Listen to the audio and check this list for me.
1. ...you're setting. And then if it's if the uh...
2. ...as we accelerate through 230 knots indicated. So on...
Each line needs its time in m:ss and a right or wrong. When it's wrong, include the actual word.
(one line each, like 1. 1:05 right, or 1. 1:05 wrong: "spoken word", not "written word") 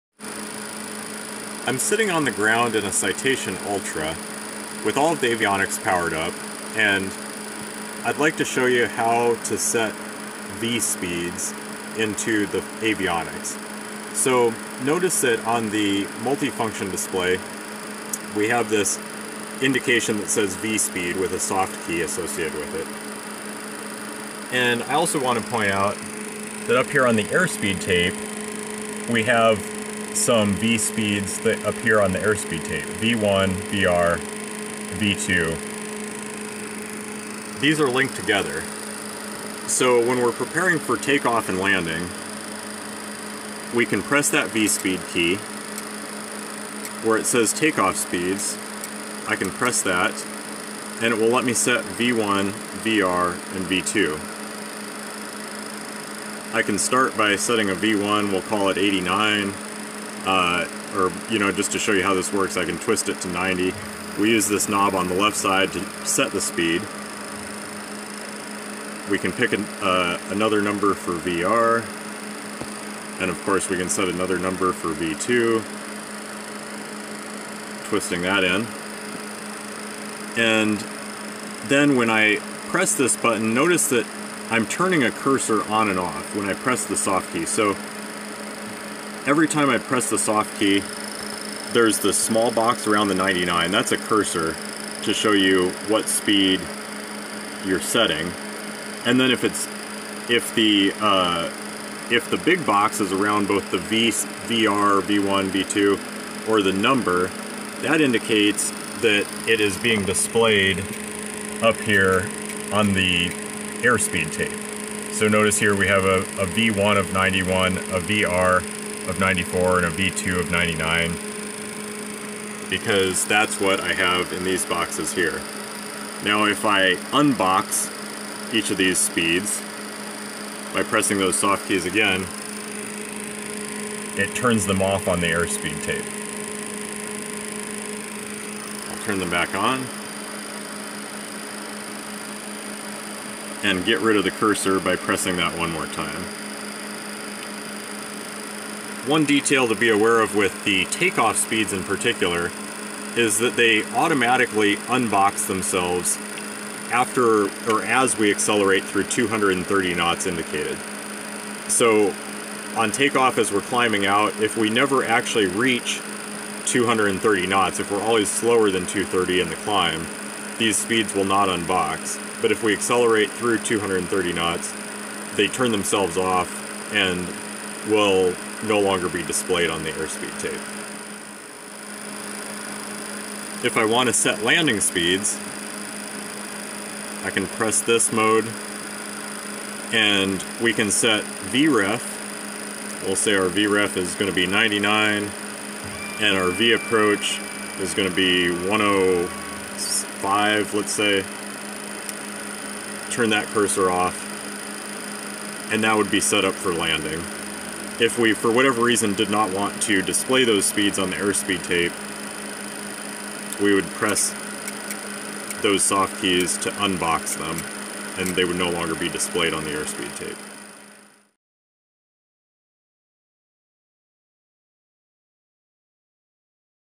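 1. 1:37 right
2. 2:37 right.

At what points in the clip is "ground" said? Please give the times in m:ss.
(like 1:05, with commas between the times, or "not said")
0:02.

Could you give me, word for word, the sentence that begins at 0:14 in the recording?
So notice that on the multifunction display we have this indication that says V-speed with a soft key associated with it.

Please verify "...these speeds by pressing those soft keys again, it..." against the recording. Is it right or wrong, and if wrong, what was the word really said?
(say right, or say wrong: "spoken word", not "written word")
right.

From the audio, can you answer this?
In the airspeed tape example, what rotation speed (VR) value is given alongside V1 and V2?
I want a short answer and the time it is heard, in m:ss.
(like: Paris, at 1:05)
94, at 1:59.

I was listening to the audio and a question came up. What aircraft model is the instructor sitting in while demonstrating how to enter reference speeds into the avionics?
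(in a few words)
Citation Ultra.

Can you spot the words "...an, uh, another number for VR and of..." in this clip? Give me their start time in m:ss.
1:09.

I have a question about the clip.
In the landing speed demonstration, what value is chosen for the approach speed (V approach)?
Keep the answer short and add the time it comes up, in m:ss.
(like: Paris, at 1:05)
105, at 3:18.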